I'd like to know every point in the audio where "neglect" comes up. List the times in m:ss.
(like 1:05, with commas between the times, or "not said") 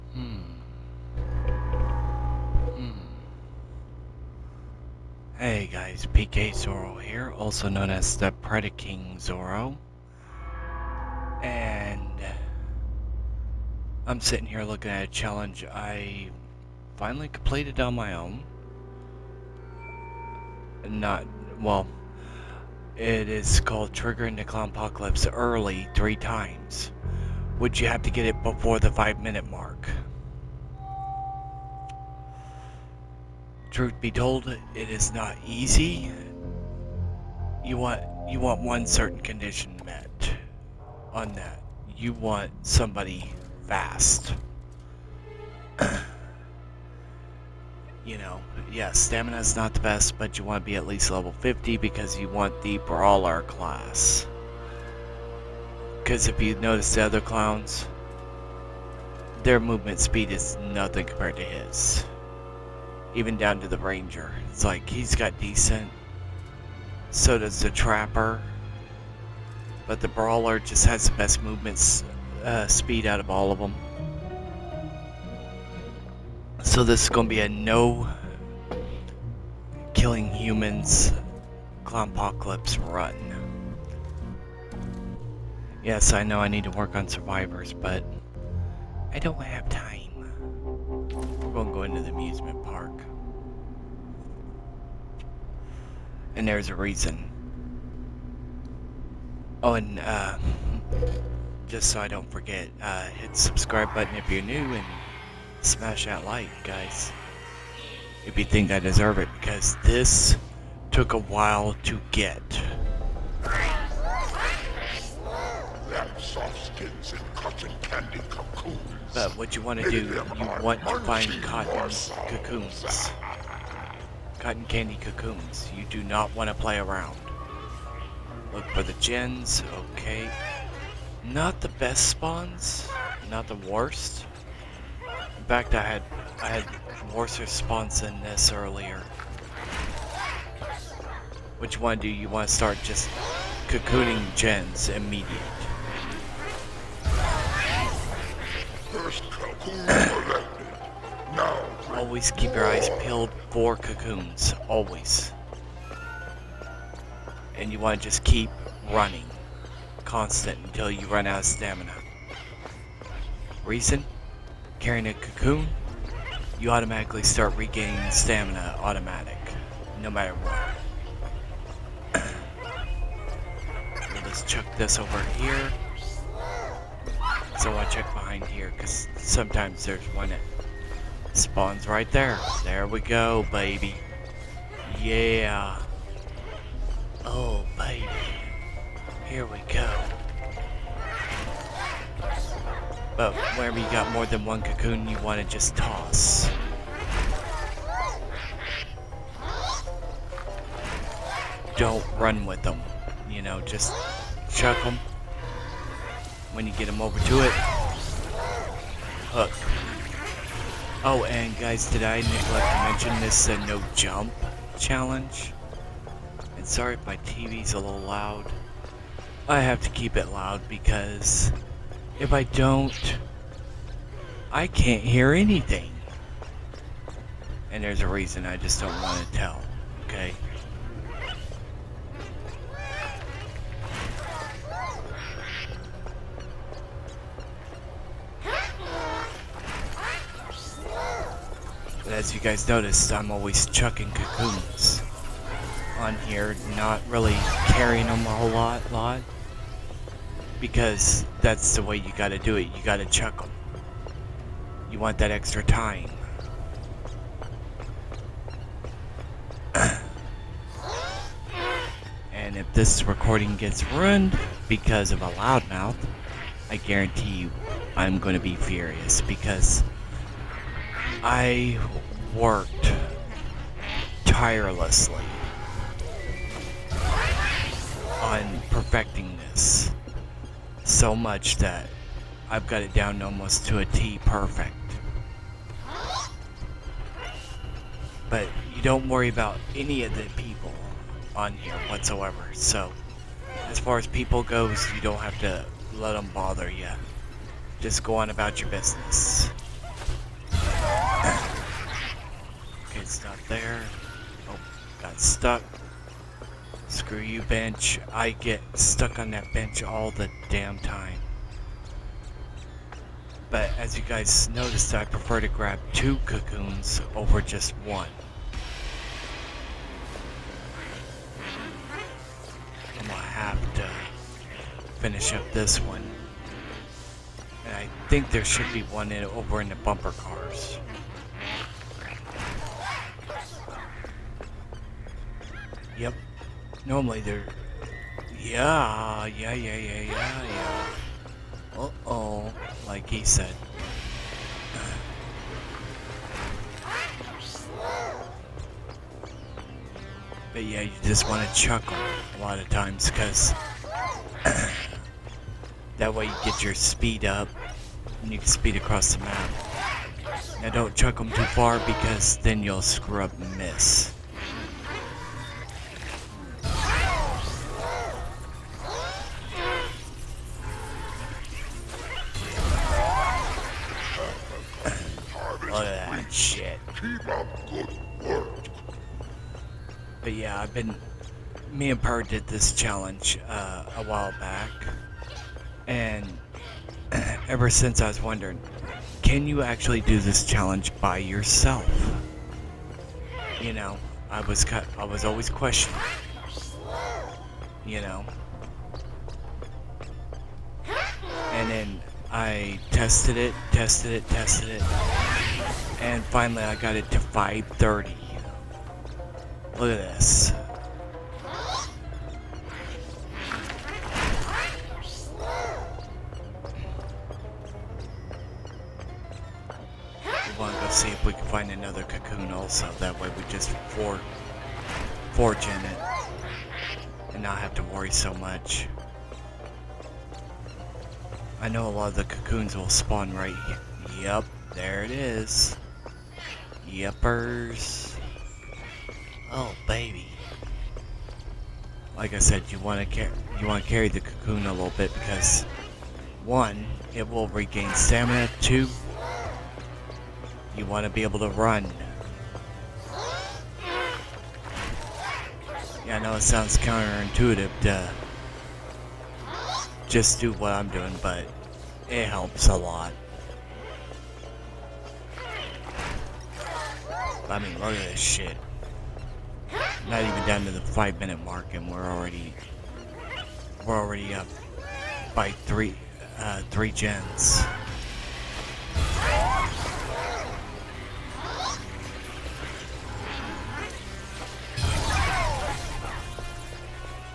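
3:32.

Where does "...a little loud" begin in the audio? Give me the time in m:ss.
3:37.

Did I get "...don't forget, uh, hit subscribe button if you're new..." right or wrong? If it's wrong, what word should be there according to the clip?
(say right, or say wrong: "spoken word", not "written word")
right.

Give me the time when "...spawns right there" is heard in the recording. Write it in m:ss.
3:01.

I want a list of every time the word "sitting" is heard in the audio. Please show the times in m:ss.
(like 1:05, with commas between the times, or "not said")
0:14.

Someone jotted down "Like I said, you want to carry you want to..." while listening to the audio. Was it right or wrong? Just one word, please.
right.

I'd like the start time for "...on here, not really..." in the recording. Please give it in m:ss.
4:05.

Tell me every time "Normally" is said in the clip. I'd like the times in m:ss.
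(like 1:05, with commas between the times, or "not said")
5:36.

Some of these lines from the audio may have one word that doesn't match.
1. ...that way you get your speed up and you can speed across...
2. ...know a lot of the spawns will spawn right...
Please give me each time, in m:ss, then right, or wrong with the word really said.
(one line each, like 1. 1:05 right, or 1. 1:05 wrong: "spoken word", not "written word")
1. 5:55 right
2. 7:11 wrong: "cocoons", not "spawns".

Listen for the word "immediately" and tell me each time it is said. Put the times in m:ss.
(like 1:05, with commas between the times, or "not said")
2:24.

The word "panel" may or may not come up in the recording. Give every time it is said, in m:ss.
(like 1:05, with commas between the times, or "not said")
not said.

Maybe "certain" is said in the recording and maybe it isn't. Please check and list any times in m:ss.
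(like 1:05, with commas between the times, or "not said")
0:38.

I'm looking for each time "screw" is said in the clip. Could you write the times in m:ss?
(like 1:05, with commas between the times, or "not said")
5:06, 6:02.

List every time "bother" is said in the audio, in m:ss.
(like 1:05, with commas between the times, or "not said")
4:56.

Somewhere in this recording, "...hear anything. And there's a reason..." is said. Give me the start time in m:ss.
3:45.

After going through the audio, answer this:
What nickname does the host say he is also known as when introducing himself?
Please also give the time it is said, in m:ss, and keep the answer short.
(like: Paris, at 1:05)
Predaking Zoro, at 0:08.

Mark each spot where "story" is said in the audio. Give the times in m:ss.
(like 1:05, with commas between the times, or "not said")
not said.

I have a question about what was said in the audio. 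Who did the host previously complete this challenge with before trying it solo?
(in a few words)
Per.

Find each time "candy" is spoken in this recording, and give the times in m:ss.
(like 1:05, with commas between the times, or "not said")
1:57, 2:04.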